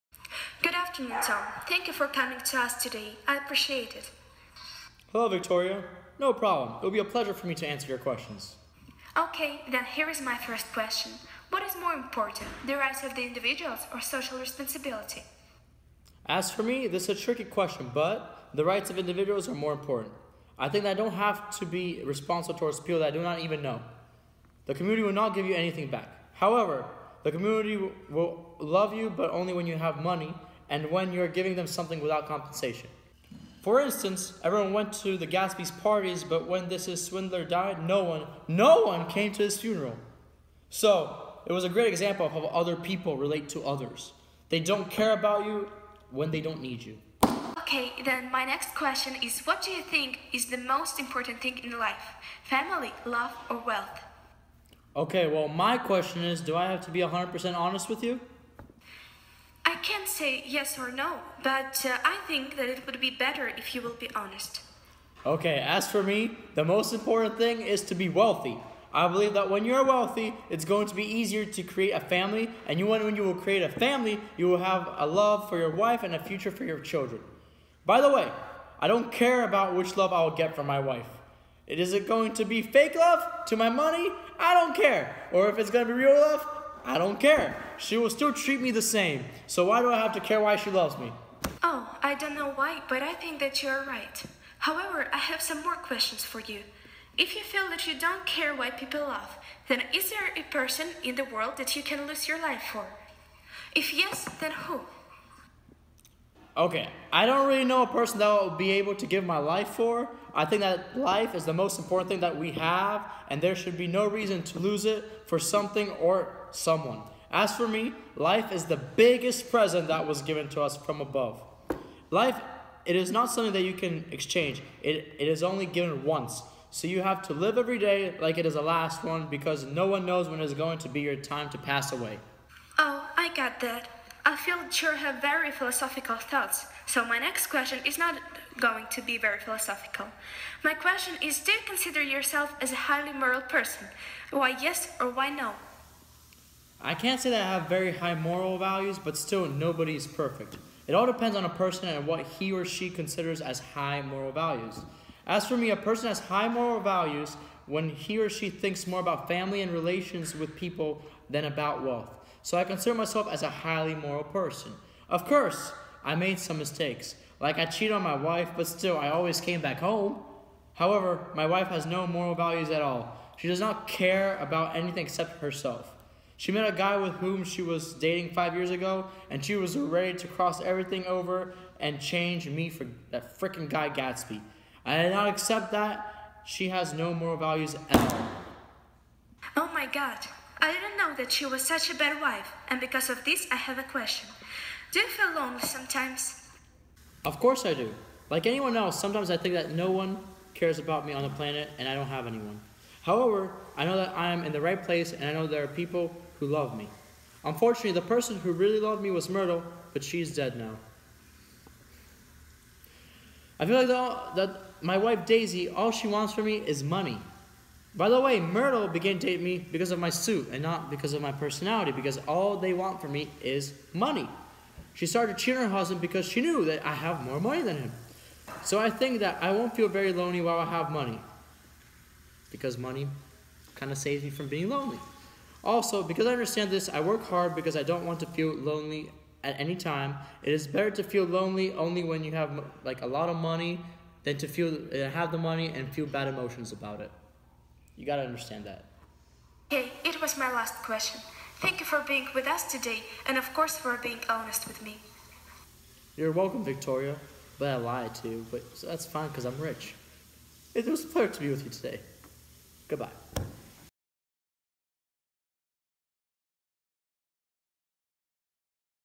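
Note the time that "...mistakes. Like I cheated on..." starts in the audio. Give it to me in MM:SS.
02:46.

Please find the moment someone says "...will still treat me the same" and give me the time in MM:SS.
01:27.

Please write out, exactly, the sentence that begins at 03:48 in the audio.
So I think that I won't feel very lonely while I have money, because money kind of saves me from being lonely.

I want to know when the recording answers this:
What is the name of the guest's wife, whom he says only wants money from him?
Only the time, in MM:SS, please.
03:35.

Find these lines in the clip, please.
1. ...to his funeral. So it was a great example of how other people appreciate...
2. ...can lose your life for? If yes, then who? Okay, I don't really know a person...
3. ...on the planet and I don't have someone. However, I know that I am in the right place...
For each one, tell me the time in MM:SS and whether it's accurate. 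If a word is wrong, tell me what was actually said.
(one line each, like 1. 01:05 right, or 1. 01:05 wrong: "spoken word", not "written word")
1. 00:39 wrong: "relate", not "appreciate"
2. 01:41 right
3. 03:21 wrong: "anyone", not "someone".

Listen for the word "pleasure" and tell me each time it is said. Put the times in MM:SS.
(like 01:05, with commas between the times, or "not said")
00:07, 04:21.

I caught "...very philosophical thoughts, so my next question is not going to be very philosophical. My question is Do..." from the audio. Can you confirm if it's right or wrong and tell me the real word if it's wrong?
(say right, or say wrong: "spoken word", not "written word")
right.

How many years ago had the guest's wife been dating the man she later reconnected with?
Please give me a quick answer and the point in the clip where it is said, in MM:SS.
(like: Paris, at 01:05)
5, at 02:58.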